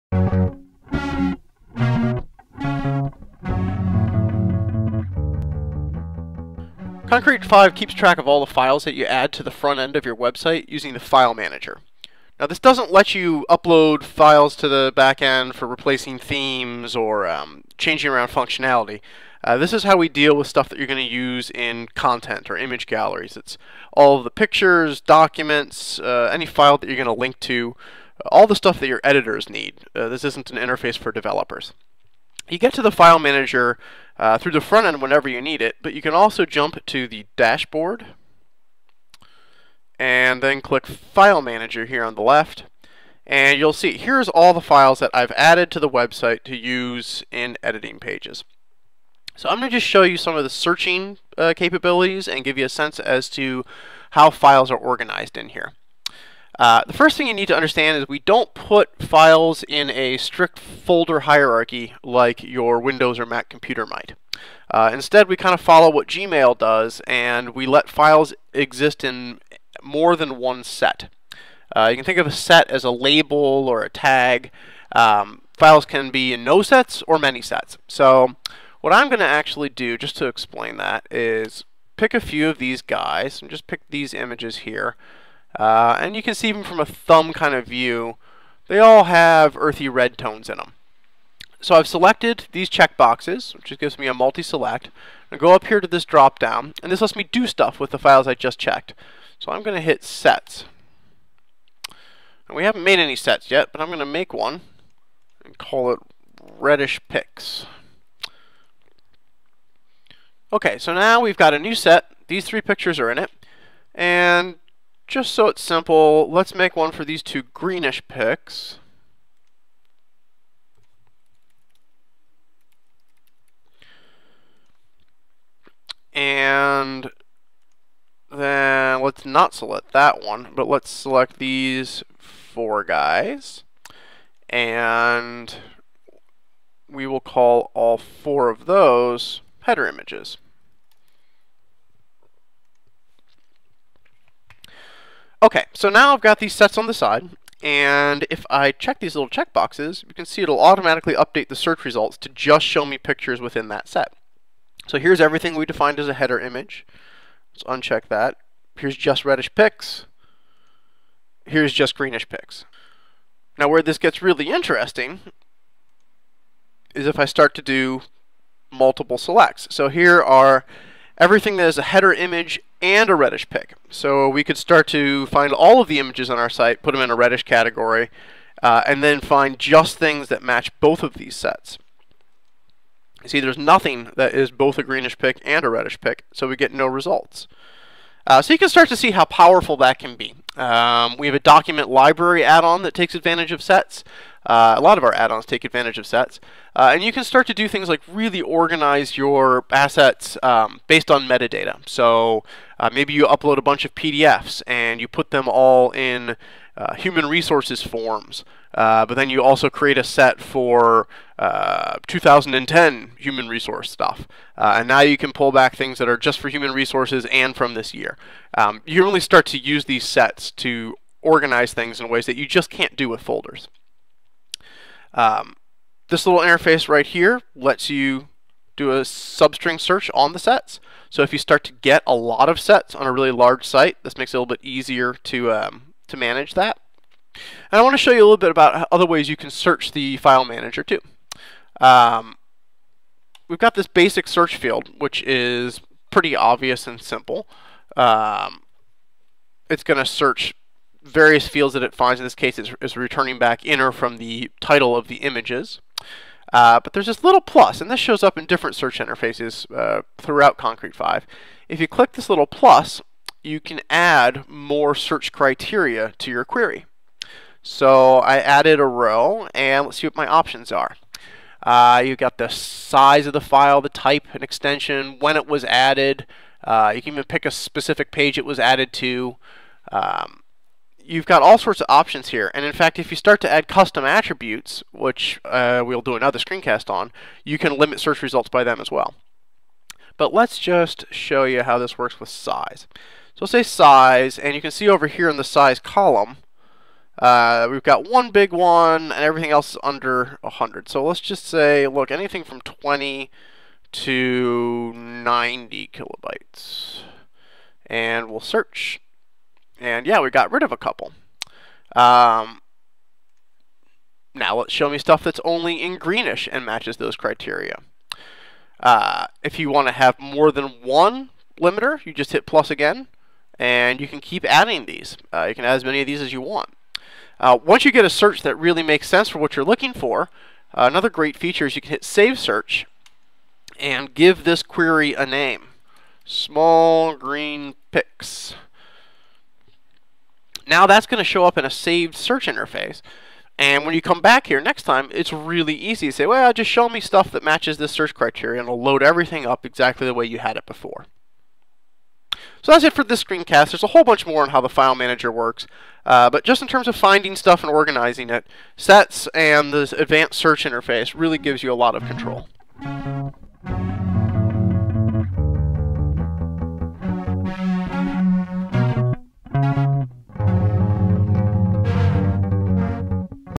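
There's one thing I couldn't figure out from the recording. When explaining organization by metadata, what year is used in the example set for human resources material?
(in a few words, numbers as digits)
2010.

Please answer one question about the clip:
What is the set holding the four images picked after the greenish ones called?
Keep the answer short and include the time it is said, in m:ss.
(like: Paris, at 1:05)
header images, at 2:19.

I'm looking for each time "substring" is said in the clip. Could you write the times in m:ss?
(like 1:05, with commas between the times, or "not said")
3:49.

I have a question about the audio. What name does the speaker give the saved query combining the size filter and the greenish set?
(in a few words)
Small green pics.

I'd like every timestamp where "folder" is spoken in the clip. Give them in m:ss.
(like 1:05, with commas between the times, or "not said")
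1:00, 3:43.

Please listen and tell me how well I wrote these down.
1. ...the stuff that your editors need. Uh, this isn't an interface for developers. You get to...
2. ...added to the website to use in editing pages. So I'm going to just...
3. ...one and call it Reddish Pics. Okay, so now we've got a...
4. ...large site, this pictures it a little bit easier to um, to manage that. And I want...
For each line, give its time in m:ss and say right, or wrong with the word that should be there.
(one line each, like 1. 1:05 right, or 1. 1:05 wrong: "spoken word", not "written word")
1. 0:28 right
2. 0:45 right
3. 1:44 right
4. 3:53 wrong: "makes", not "pictures".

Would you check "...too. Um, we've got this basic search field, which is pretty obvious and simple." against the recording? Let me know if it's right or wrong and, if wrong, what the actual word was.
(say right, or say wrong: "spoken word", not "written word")
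right.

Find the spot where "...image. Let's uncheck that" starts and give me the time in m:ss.
2:36.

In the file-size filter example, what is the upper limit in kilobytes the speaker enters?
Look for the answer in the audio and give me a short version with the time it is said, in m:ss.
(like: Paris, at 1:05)
90, at 5:04.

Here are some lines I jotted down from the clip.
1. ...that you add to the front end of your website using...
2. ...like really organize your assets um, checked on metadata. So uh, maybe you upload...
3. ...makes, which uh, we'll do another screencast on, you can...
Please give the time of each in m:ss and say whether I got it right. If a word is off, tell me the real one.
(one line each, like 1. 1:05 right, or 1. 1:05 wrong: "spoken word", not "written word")
1. 0:08 right
2. 3:17 wrong: "based", not "checked"
3. 4:44 wrong: "attributes", not "makes".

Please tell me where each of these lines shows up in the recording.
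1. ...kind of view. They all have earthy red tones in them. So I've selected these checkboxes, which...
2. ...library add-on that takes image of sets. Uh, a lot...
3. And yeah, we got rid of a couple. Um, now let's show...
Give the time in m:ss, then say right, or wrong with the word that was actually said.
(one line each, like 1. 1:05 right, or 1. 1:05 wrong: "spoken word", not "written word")
1. 1:27 right
2. 3:11 wrong: "advantage", not "image"
3. 5:09 right.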